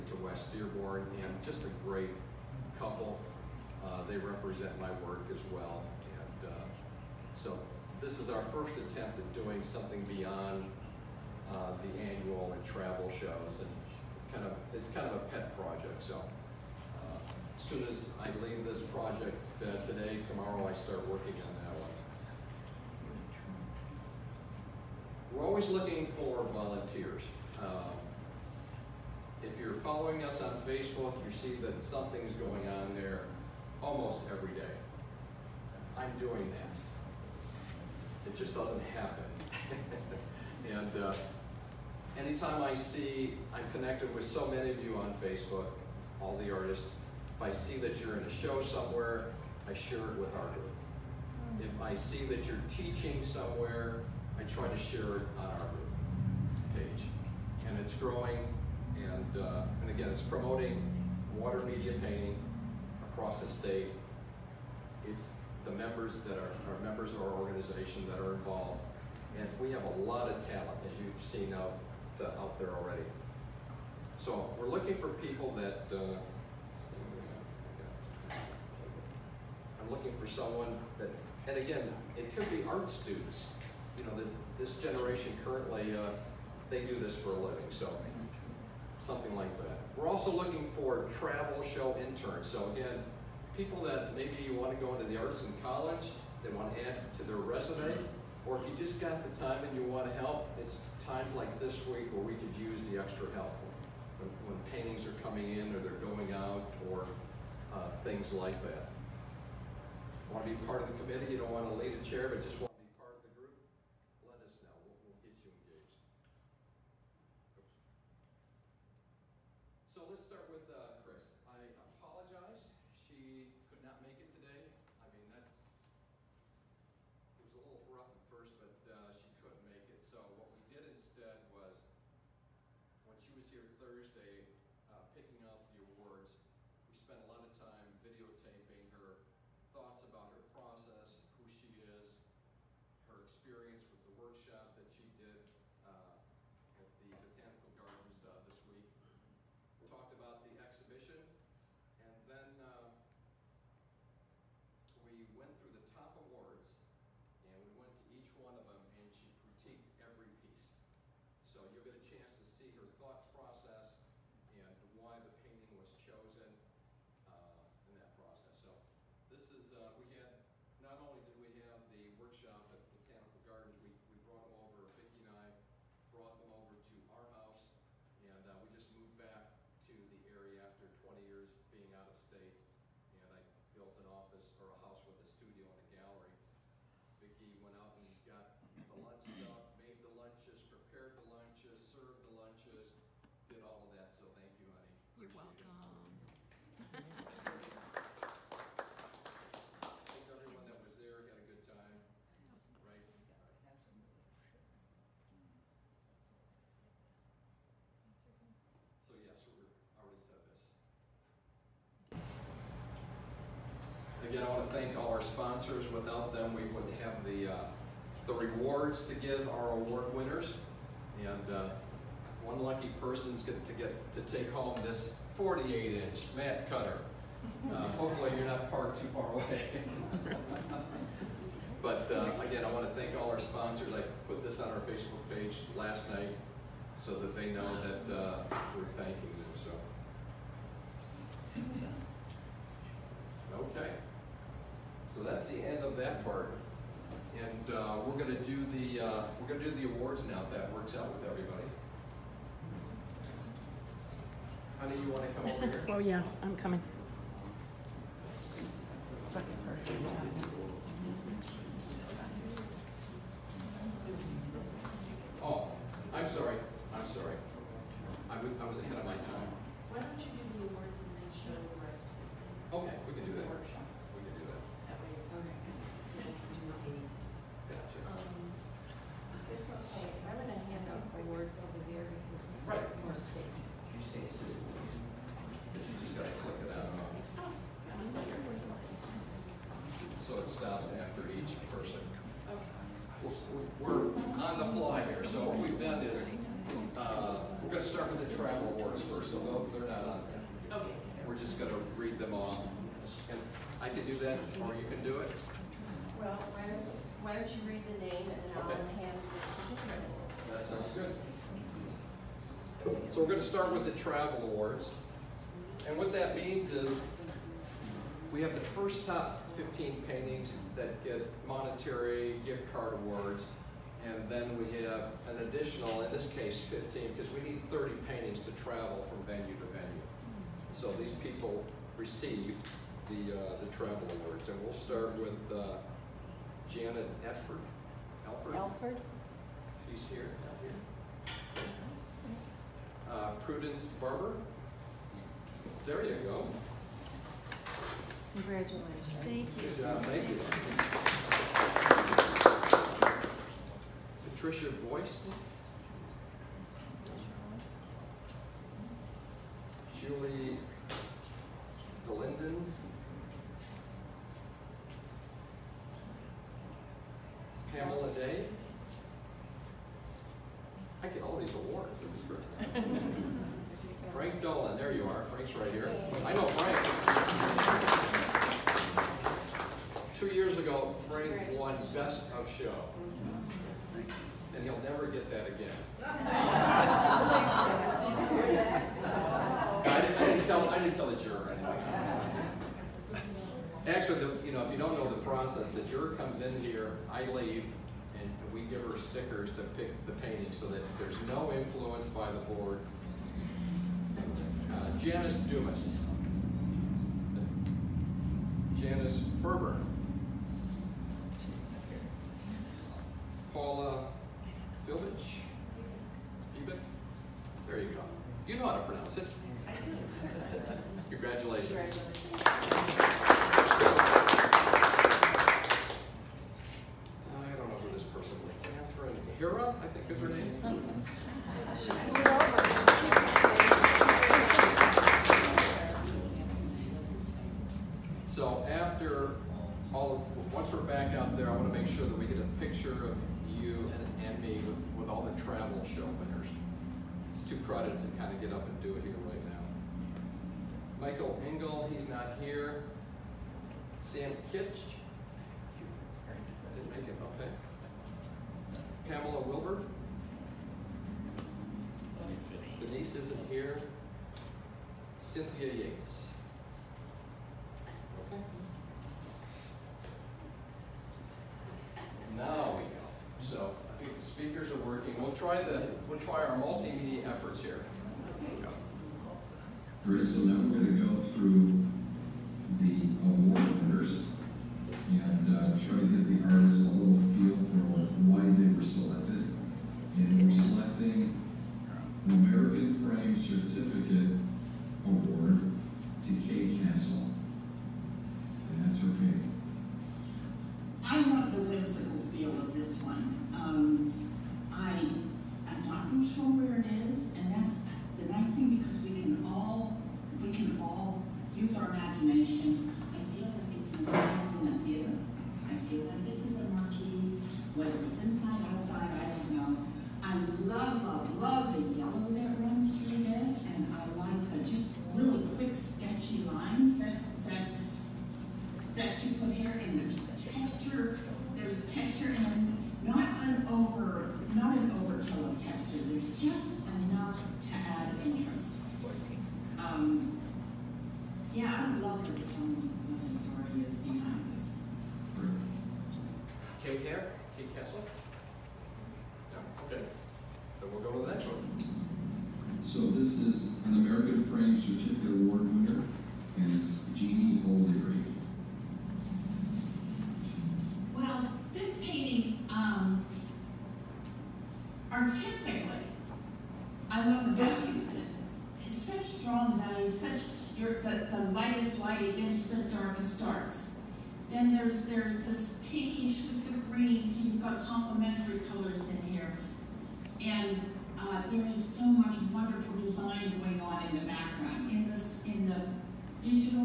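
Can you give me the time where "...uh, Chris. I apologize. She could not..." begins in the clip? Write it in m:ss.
2:00.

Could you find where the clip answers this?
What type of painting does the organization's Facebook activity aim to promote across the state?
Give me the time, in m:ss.
1:01.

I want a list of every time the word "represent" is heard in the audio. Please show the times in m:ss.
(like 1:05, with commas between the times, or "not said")
0:04.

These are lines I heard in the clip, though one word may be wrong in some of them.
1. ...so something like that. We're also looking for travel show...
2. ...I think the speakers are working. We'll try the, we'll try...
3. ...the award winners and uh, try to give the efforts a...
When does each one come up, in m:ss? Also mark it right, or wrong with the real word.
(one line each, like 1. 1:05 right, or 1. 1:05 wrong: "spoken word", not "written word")
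1. 1:27 right
2. 7:53 right
3. 8:02 wrong: "artists", not "efforts".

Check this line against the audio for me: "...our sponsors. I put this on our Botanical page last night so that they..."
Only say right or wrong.
wrong.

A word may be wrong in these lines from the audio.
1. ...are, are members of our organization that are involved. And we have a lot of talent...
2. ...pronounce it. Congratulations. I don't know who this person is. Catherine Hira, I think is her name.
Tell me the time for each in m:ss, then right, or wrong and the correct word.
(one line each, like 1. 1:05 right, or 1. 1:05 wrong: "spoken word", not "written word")
1. 1:06 right
2. 6:58 right.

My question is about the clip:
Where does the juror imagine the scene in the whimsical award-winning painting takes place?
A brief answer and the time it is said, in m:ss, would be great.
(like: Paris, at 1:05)
a theater, at 8:34.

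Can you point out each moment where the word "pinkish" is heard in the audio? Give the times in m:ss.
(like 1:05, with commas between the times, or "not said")
9:35.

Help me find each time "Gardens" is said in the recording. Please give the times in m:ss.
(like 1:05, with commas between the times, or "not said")
2:27, 2:53.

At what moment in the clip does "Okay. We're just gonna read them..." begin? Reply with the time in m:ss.
5:00.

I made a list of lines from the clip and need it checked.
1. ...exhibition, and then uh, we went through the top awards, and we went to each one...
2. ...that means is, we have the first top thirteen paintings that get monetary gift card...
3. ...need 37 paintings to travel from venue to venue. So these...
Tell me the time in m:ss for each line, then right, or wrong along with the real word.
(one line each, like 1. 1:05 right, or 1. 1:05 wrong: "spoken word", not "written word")
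1. 2:30 right
2. 5:16 wrong: "fifteen", not "thirteen"
3. 5:27 wrong: "30", not "37".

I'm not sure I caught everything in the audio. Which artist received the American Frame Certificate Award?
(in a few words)
Kay Castle.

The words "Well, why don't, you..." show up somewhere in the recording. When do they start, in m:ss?
5:06.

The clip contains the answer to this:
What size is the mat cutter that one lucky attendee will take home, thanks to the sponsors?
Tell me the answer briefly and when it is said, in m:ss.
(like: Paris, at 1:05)
48-inch, at 3:45.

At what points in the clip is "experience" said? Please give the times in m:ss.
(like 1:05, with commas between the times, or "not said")
2:23.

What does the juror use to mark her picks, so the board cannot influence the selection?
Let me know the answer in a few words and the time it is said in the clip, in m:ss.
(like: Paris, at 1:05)
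stickers, at 6:38.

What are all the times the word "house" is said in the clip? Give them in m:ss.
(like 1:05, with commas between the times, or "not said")
2:57, 3:04.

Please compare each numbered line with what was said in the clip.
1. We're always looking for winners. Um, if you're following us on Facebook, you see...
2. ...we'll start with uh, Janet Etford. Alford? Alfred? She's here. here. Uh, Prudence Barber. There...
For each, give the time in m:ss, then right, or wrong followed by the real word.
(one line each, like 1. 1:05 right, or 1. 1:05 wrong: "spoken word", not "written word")
1. 0:25 wrong: "volunteers", not "winners"
2. 5:34 right.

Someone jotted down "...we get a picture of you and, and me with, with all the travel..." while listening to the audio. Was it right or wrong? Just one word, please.
right.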